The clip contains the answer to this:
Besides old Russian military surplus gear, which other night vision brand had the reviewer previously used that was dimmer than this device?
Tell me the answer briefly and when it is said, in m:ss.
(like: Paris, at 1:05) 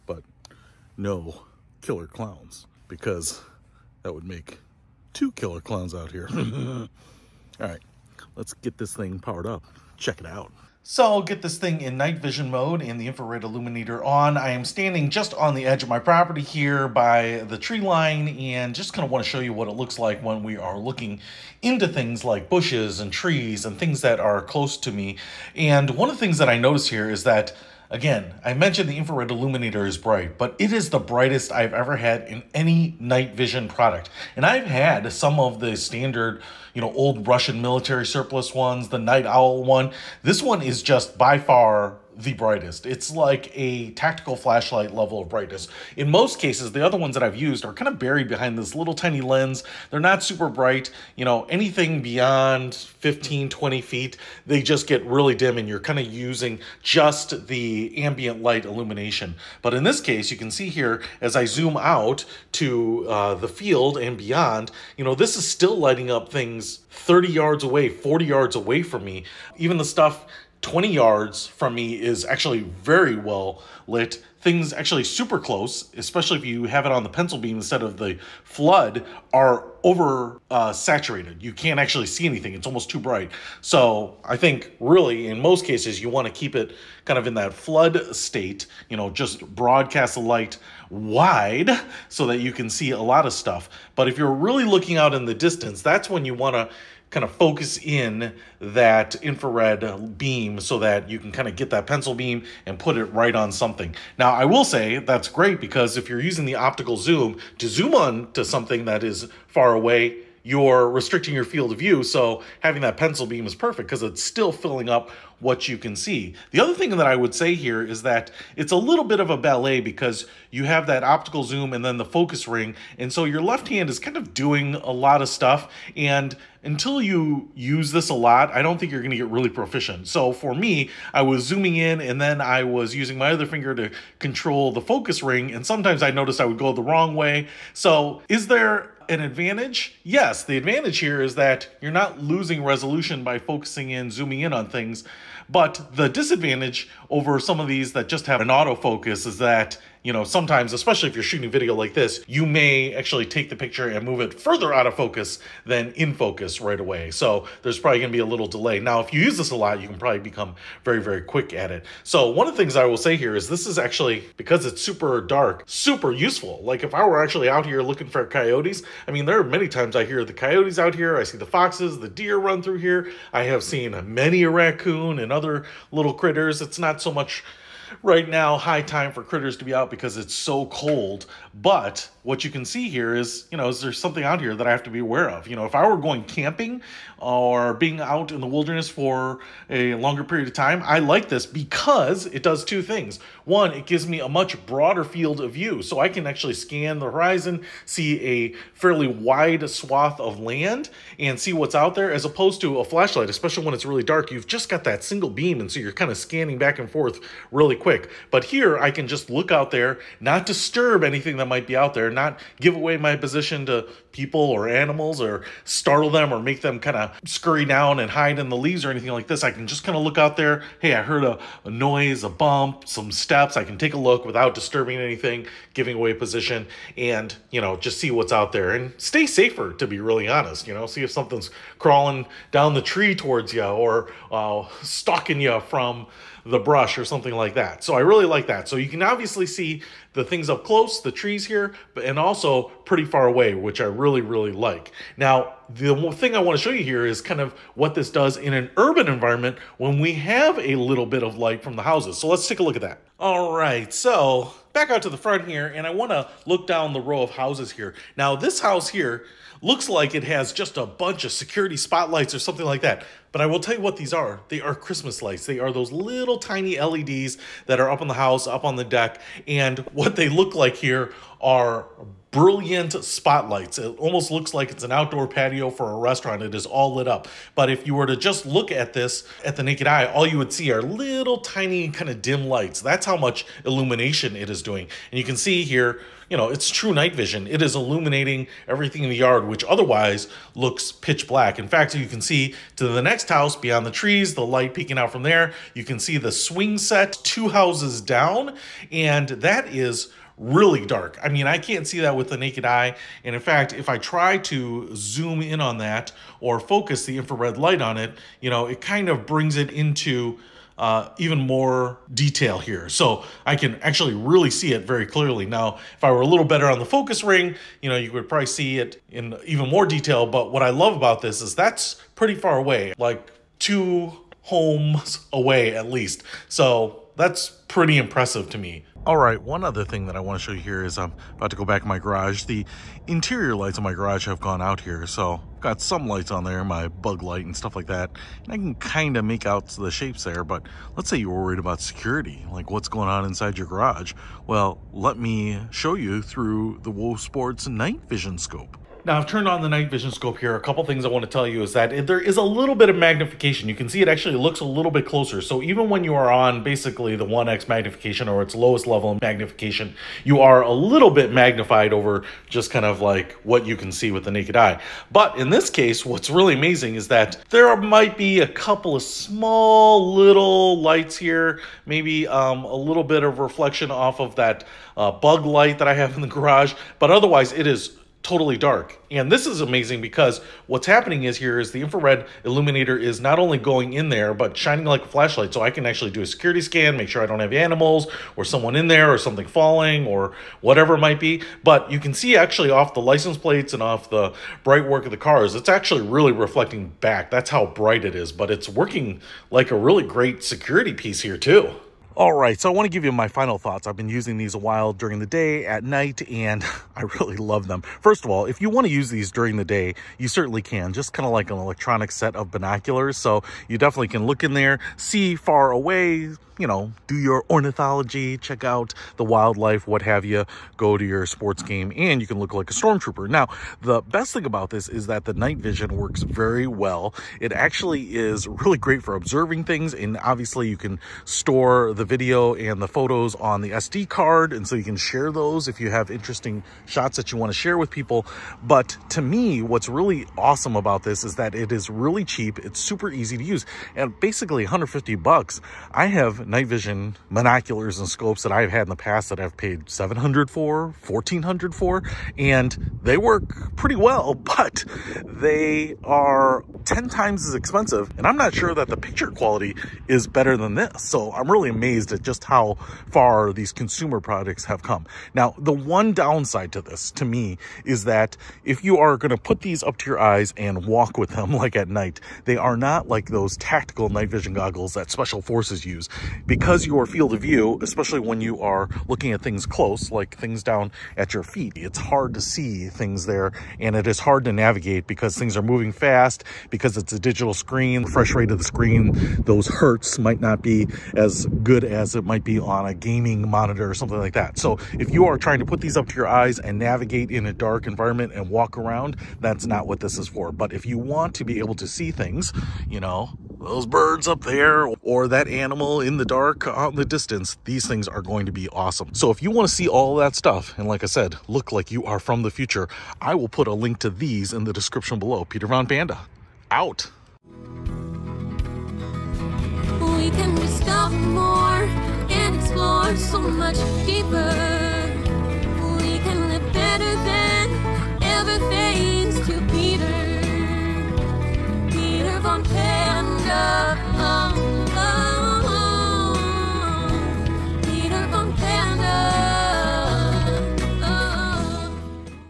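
Night Owl, at 0:38.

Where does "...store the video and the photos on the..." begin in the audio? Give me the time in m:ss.
7:11.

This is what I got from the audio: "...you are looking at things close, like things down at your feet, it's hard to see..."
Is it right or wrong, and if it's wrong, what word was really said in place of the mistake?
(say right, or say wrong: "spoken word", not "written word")
right.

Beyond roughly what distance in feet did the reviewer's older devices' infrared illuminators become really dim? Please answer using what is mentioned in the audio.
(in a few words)
15, 20 feet.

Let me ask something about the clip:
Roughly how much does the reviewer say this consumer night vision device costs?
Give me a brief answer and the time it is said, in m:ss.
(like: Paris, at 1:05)
$150, at 7:24.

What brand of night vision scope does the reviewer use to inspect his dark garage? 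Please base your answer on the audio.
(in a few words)
WOSPORTS.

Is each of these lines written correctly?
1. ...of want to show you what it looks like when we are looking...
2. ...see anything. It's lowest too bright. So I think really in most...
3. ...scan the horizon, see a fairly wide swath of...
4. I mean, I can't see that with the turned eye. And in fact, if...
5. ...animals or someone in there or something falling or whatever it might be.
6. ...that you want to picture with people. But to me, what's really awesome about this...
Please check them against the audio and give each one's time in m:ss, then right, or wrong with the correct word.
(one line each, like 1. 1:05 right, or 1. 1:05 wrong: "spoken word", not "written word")
1. 0:19 right
2. 1:22 wrong: "almost", not "lowest"
3. 3:16 right
4. 5:01 wrong: "naked", not "turned"
5. 6:27 right
6. 7:17 wrong: "share", not "picture".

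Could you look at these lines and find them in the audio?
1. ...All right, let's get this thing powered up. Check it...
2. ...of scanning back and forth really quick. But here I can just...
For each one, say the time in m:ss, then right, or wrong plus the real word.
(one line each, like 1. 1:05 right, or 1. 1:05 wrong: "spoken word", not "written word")
1. 0:06 right
2. 3:26 right.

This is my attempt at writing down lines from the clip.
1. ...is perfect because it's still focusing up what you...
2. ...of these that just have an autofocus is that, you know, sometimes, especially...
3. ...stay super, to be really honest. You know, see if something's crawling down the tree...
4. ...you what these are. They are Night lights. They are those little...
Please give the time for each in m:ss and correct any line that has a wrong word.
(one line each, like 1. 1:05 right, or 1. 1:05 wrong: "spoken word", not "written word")
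1. 1:53 wrong: "filling", not "focusing"
2. 2:27 right
3. 3:48 wrong: "safer", not "super"
4. 4:23 wrong: "Christmas", not "Night".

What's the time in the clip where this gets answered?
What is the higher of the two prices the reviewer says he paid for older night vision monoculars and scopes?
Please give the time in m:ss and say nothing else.
7:31.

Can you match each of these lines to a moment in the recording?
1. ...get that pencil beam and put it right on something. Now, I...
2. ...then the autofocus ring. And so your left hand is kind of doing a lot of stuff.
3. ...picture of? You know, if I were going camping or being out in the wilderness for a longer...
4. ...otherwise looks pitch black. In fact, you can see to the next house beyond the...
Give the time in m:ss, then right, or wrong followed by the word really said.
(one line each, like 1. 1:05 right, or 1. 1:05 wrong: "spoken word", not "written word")
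1. 1:41 right
2. 2:01 wrong: "focus", not "autofocus"
3. 3:04 wrong: "aware", not "picture"
4. 4:49 right.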